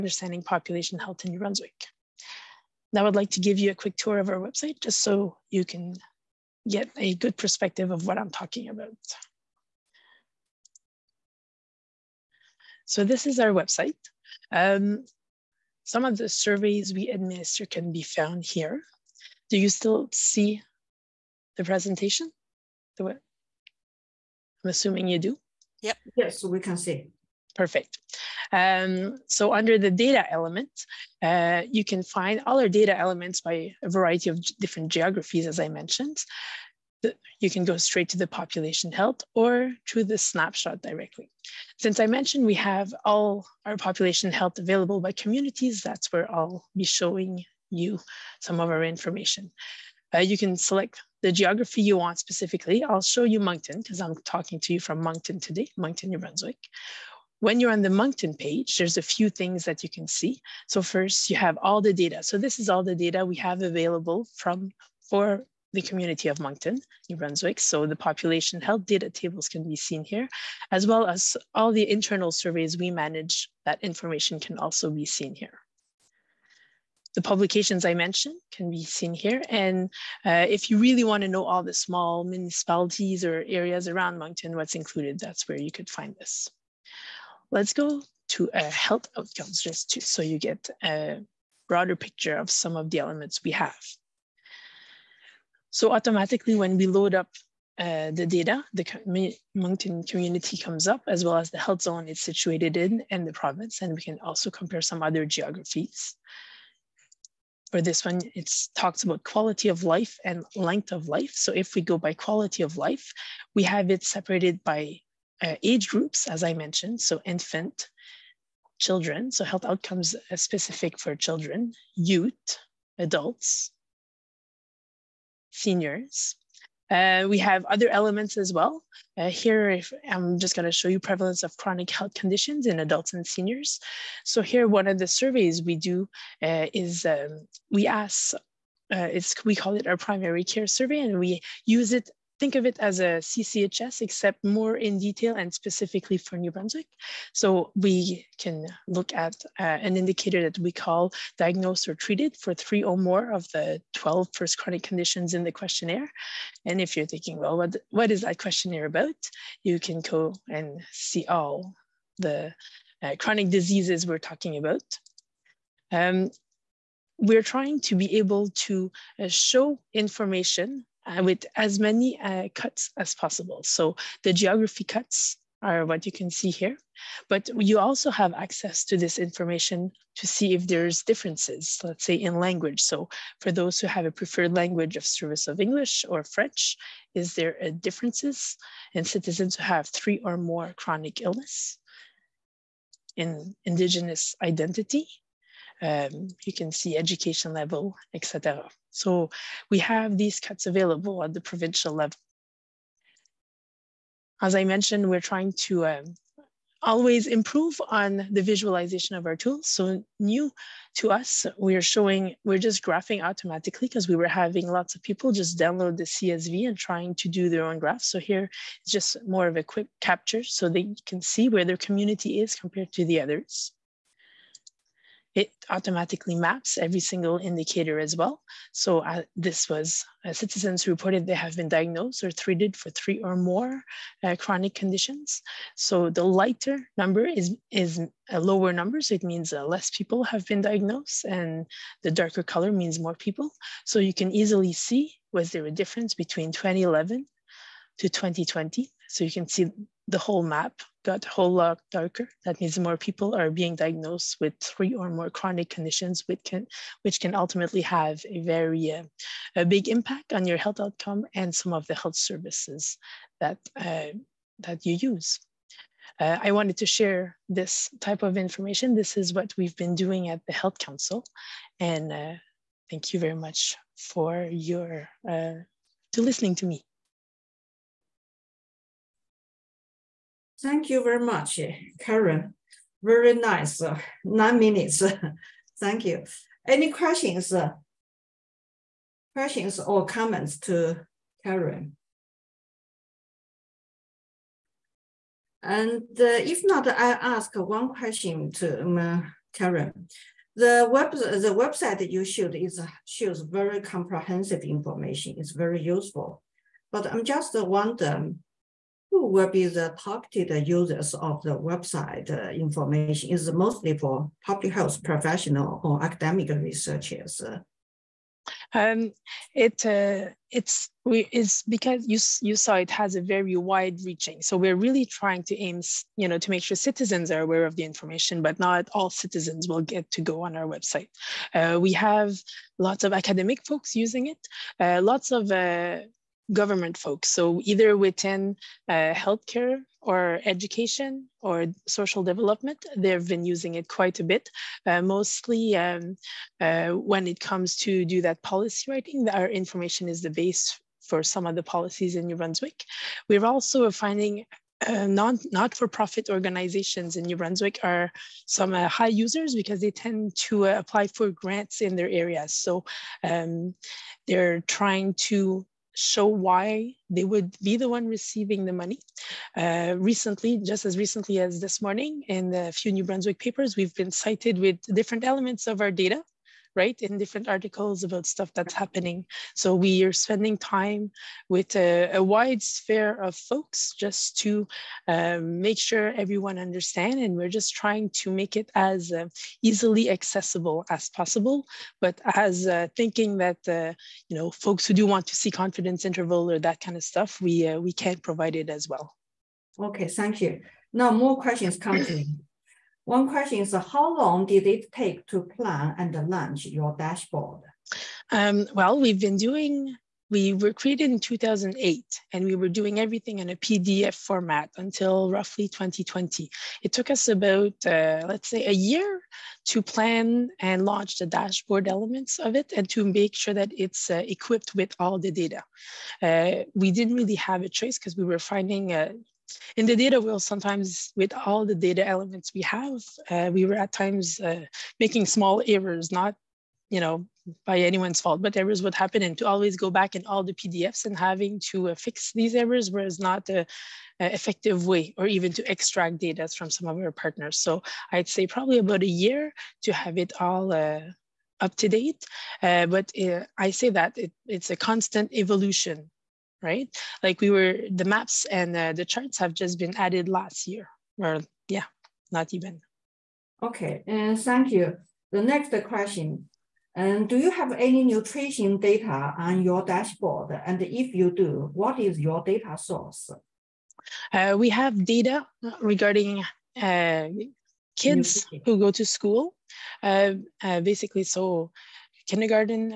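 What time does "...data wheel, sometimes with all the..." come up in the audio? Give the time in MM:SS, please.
07:09.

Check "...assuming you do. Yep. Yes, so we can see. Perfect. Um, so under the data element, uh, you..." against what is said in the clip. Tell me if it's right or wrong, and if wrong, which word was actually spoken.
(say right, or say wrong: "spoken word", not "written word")
right.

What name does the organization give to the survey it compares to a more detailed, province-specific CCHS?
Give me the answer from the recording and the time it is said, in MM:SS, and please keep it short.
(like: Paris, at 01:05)
primary care survey, at 02:19.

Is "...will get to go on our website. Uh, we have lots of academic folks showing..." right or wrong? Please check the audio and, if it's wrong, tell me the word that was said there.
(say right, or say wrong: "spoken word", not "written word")
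wrong: "using", not "showing".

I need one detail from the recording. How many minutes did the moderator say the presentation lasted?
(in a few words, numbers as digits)
9.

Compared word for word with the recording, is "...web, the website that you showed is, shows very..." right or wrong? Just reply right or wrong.
right.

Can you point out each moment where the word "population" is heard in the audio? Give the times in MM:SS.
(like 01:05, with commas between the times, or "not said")
00:00, 00:38, 00:43, 01:07.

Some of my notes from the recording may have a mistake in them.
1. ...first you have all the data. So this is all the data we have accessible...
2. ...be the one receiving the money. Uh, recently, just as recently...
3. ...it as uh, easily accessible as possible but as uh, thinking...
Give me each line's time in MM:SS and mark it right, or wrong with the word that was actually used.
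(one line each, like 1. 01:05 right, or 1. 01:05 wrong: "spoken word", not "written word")
1. 01:00 wrong: "available", not "accessible"
2. 06:07 right
3. 06:28 right.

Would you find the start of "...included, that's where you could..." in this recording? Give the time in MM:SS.
01:24.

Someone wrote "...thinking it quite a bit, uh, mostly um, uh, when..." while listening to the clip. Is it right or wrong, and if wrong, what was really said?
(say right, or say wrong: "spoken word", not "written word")
wrong: "using", not "thinking".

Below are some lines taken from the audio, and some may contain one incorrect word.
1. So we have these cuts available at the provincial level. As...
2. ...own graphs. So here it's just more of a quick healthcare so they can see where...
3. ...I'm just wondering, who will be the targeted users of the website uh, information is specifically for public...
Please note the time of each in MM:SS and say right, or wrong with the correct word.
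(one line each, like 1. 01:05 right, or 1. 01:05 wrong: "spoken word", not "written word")
1. 03:18 right
2. 03:37 wrong: "capture", not "healthcare"
3. 05:07 wrong: "mostly", not "specifically".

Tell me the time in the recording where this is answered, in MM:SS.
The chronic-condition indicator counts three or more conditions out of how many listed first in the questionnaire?
02:33.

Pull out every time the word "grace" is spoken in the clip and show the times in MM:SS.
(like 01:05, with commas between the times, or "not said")
not said.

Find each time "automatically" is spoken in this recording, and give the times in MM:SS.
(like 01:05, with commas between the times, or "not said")
01:35, 03:33, 03:45.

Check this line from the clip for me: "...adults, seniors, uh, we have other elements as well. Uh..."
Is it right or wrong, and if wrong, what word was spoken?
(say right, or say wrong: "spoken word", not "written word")
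right.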